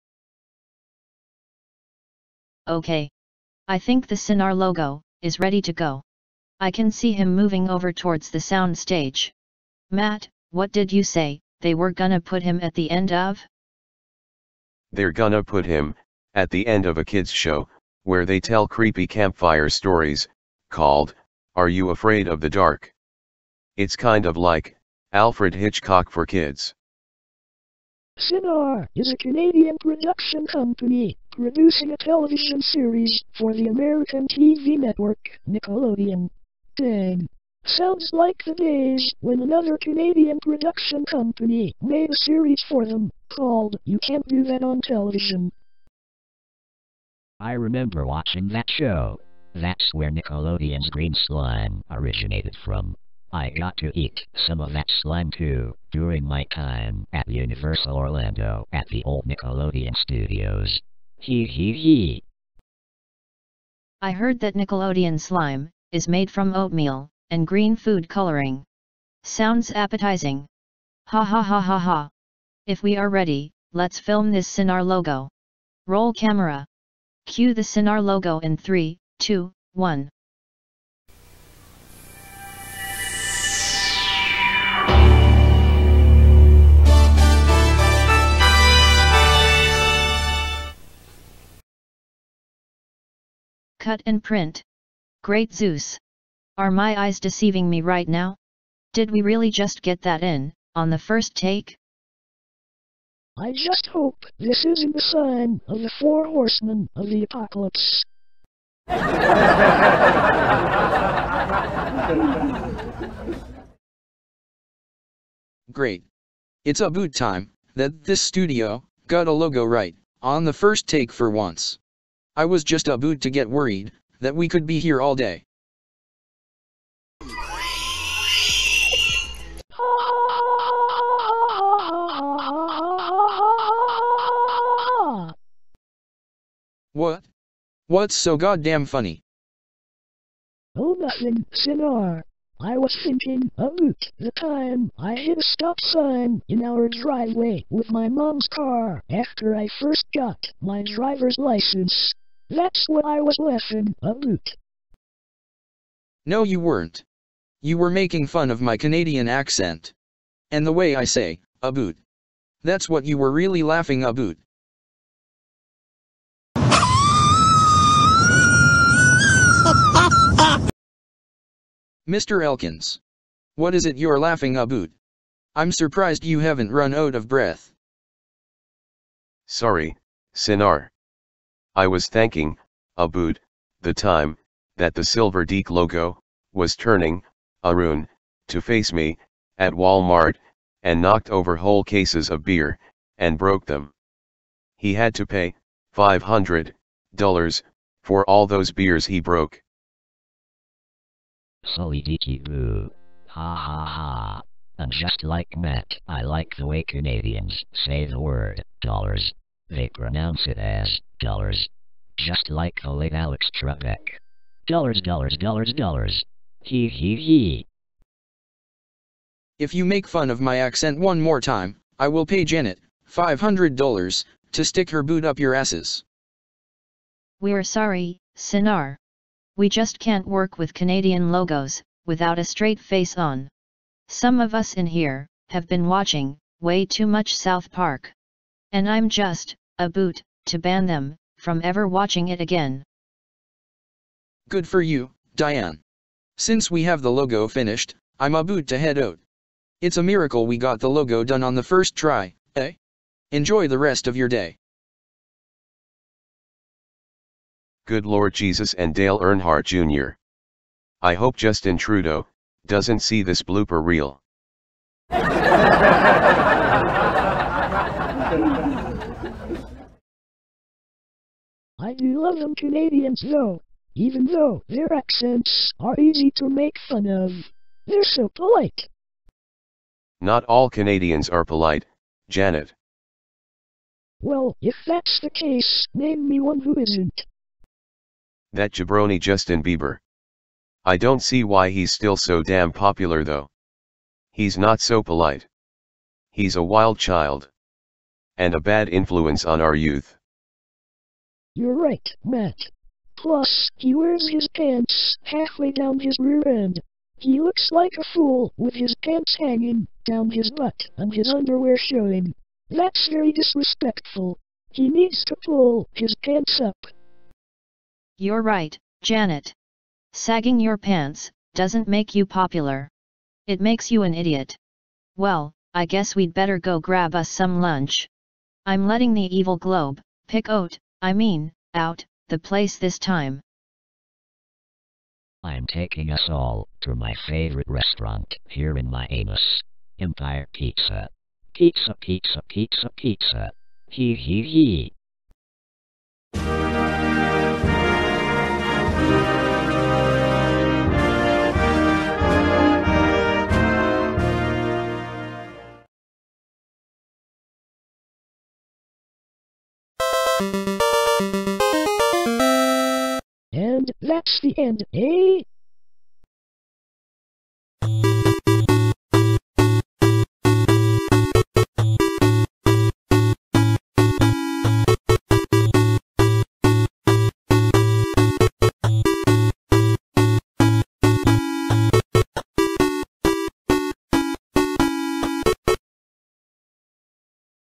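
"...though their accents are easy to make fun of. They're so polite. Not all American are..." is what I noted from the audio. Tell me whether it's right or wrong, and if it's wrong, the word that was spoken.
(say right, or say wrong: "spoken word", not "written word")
wrong: "Canadians", not "American".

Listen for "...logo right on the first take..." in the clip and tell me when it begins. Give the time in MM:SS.
01:59.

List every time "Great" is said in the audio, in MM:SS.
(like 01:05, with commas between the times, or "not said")
01:35, 01:55.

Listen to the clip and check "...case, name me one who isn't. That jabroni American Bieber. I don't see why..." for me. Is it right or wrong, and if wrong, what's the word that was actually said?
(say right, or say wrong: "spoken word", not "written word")
wrong: "Justin", not "American".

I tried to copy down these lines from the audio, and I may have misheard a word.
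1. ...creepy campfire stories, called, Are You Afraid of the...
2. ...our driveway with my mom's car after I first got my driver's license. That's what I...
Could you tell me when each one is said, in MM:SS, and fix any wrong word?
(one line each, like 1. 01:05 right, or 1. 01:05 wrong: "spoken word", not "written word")
1. 00:18 right
2. 02:26 right.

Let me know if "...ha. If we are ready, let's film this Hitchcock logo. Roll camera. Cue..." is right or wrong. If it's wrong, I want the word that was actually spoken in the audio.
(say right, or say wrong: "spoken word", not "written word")
wrong: "Cinar", not "Hitchcock".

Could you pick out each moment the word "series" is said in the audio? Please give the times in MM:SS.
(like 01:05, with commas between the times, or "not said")
00:32, 00:42.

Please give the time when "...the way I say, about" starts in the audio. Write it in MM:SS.
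02:40.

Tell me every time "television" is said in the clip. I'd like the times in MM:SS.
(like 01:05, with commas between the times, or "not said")
00:31, 00:44.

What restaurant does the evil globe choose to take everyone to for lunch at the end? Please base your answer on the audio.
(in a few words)
Empire Pizza.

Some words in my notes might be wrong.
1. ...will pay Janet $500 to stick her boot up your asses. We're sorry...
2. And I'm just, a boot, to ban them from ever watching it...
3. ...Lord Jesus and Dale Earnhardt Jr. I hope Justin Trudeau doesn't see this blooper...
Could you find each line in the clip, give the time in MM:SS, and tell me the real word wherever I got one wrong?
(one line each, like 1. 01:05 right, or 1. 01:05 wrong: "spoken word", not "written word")
1. 03:42 right
2. 03:58 right
3. 04:18 right.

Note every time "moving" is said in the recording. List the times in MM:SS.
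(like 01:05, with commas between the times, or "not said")
00:07.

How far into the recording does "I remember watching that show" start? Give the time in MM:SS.
00:47.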